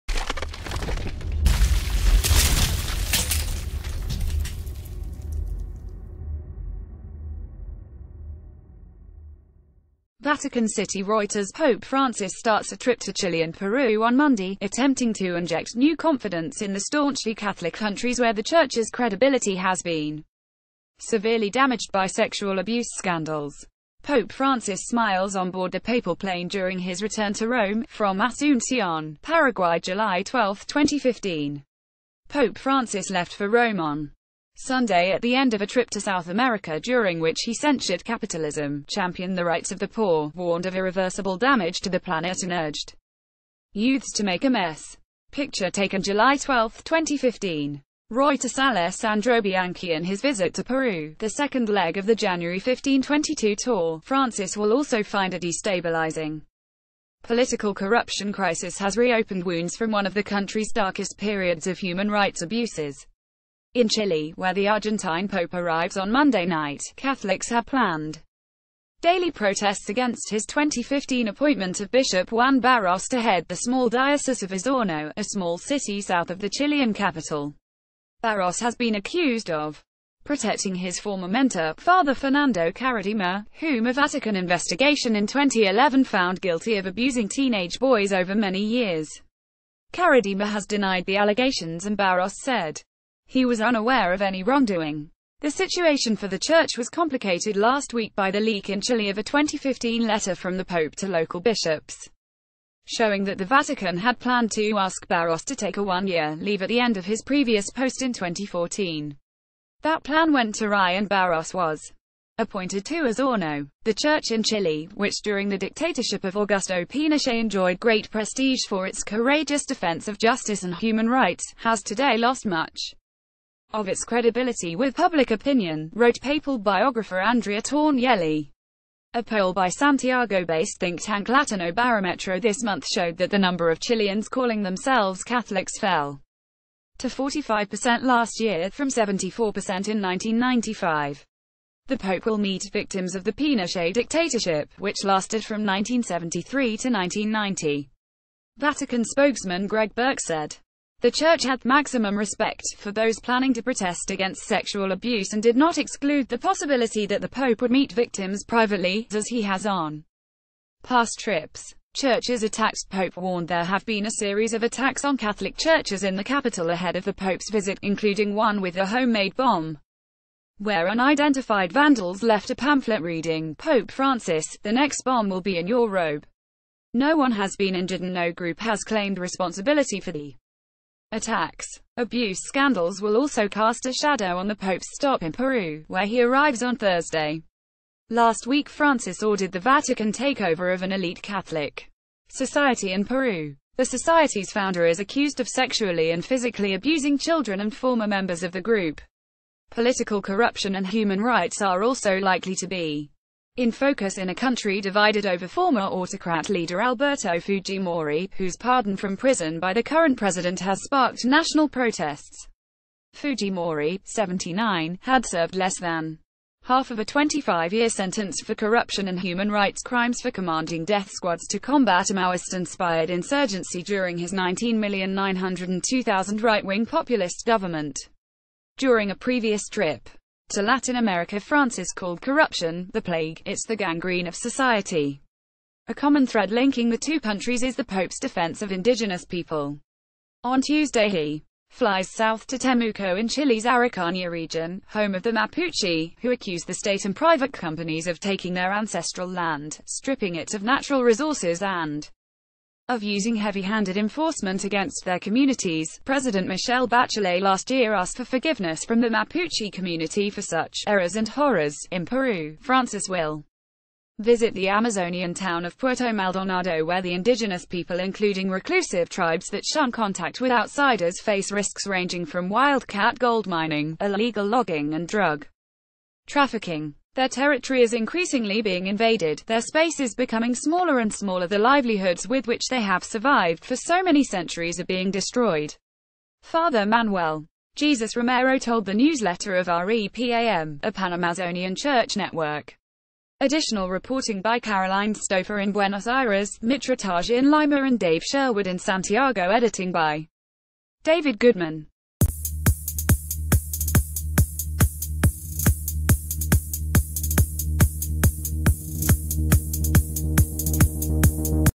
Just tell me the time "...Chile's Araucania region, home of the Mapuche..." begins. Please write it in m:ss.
4:03.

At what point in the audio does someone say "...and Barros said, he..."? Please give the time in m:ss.
1:31.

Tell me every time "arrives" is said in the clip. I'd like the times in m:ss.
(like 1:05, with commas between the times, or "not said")
1:05, 3:06.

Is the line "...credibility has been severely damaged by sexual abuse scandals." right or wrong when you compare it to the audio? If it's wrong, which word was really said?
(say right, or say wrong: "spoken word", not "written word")
right.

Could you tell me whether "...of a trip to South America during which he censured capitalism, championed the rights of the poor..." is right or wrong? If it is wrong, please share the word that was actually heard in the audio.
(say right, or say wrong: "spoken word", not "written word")
right.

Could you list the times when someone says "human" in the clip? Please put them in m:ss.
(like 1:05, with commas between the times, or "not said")
1:01, 2:00, 3:20, 3:39.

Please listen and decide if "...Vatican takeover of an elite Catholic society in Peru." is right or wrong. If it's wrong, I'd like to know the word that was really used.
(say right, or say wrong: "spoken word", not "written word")
right.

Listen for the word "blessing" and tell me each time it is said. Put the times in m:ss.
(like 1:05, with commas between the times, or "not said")
not said.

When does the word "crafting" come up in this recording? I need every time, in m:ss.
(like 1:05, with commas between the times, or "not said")
not said.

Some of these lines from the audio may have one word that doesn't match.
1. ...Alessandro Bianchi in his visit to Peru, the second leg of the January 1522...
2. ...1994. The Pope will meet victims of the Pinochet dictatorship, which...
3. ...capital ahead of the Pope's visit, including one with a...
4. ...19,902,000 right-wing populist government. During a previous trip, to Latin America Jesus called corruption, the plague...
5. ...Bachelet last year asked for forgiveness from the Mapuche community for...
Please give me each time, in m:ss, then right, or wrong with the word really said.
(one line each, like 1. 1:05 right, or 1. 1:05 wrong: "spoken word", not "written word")
1. 0:48 right
2. 2:20 wrong: "1995", not "1994"
3. 2:46 right
4. 3:44 wrong: "Francis", not "Jesus"
5. 4:16 right.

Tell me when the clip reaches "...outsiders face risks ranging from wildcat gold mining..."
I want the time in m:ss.
4:30.